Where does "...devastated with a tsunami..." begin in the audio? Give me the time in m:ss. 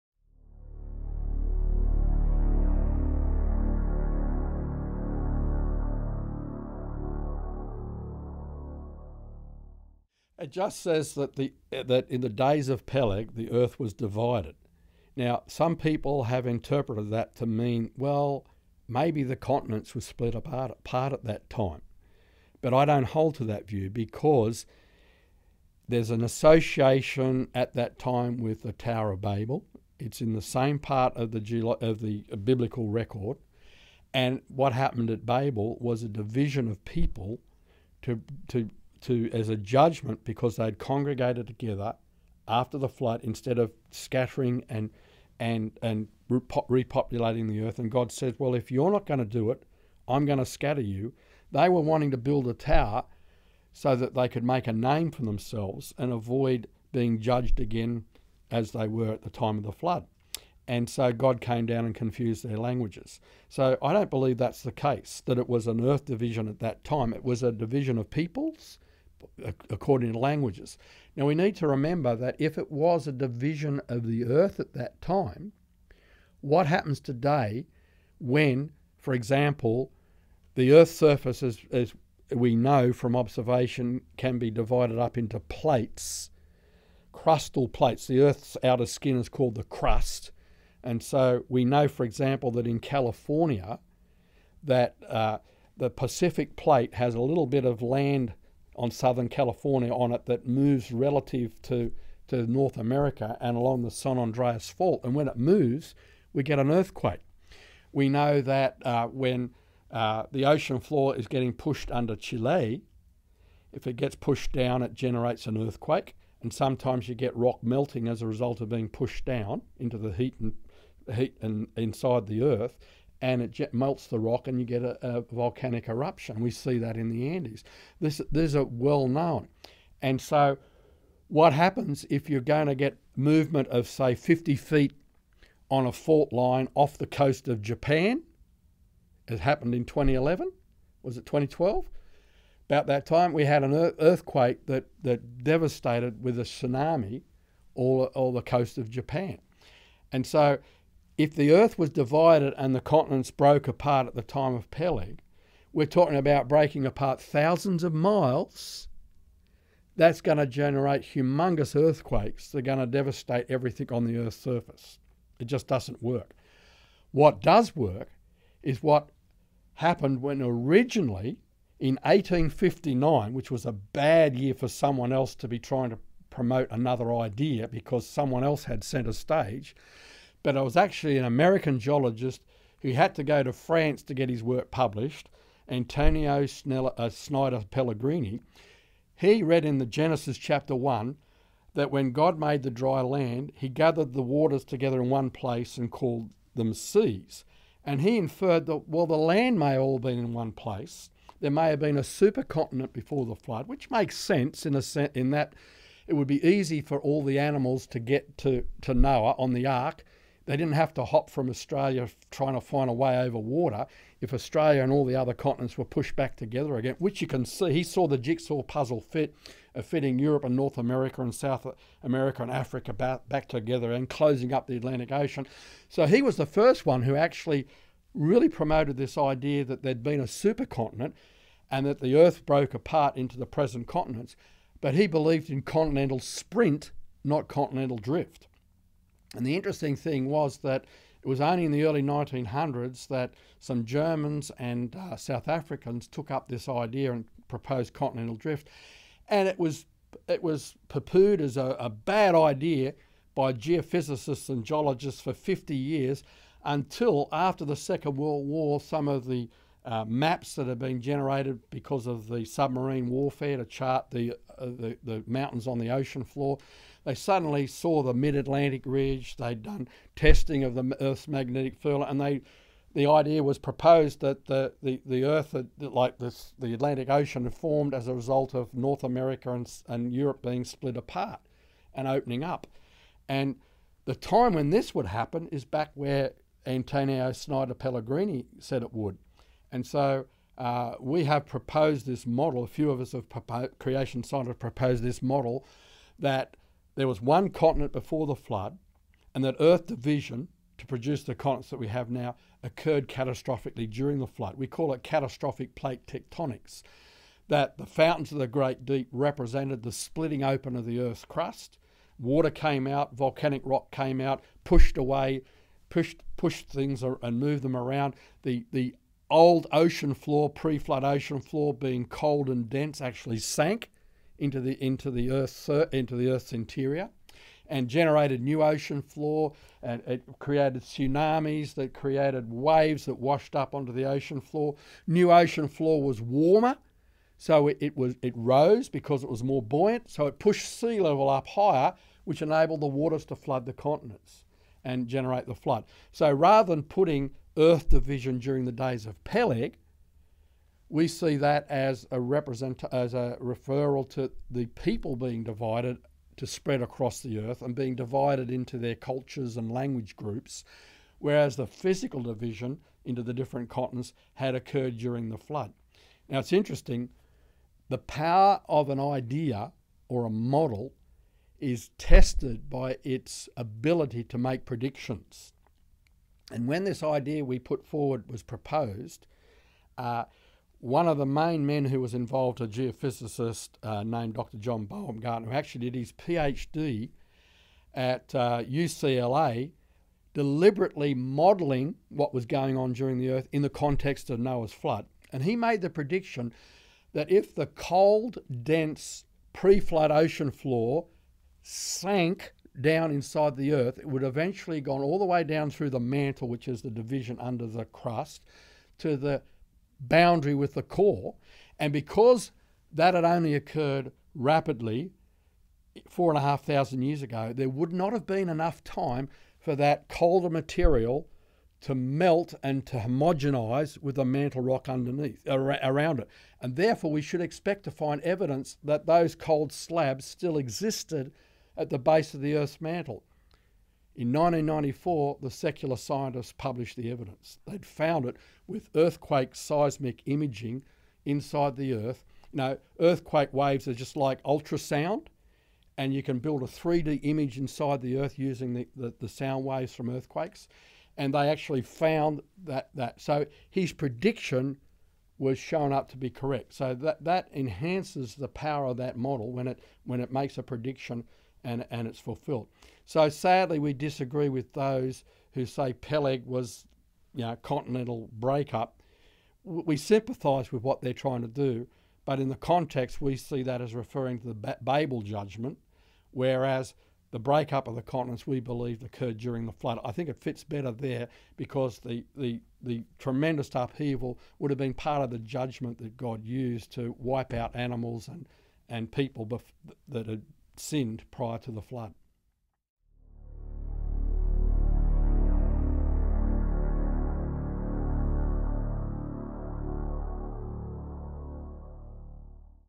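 2:25.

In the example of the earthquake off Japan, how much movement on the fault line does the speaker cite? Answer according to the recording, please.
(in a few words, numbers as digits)
50 feet.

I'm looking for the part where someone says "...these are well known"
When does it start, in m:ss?
2:08.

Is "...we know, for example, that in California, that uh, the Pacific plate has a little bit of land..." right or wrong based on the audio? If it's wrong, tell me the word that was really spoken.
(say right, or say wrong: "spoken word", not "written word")
right.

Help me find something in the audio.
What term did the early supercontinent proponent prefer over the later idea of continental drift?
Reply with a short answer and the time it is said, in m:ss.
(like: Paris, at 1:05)
continental sprint, at 3:55.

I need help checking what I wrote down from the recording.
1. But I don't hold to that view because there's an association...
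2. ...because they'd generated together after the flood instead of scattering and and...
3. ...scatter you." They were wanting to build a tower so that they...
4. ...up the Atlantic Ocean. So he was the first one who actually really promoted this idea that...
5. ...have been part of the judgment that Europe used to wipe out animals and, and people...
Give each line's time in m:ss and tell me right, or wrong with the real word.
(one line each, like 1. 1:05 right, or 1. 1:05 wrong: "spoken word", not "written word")
1. 0:22 right
2. 0:40 wrong: "congregated", not "generated"
3. 0:50 right
4. 3:44 right
5. 8:04 wrong: "God", not "Europe".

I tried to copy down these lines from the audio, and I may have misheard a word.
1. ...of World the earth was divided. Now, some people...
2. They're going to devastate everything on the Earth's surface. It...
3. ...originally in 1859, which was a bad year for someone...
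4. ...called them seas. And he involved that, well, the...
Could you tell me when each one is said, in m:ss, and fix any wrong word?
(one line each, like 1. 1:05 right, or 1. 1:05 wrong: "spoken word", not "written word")
1. 0:12 wrong: "Peleg", not "World"
2. 2:42 right
3. 2:50 right
4. 3:15 wrong: "inferred", not "involved".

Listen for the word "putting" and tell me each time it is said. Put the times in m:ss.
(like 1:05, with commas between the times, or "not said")
5:46.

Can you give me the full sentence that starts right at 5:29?
And it created tsunamis that created waves that washed up onto the ocean floor.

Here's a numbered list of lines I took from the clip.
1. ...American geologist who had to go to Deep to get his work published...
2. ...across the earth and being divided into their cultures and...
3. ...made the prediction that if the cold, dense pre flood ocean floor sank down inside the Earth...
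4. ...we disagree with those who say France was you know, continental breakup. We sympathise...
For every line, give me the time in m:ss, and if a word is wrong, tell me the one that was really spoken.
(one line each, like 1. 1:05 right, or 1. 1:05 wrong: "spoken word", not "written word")
1. 3:01 wrong: "France", not "Deep"
2. 5:56 right
3. 6:35 right
4. 7:43 wrong: "Peleg", not "France".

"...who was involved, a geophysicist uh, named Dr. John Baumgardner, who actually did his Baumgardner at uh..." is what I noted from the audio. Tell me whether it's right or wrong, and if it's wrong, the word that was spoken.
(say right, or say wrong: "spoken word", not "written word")
wrong: "PhD", not "Baumgardner".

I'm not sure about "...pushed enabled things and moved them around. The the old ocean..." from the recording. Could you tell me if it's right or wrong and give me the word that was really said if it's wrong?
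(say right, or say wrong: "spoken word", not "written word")
wrong: "pushed", not "enabled".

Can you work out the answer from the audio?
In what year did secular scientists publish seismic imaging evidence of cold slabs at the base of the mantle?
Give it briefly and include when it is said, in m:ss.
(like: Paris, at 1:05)
1994, at 7:14.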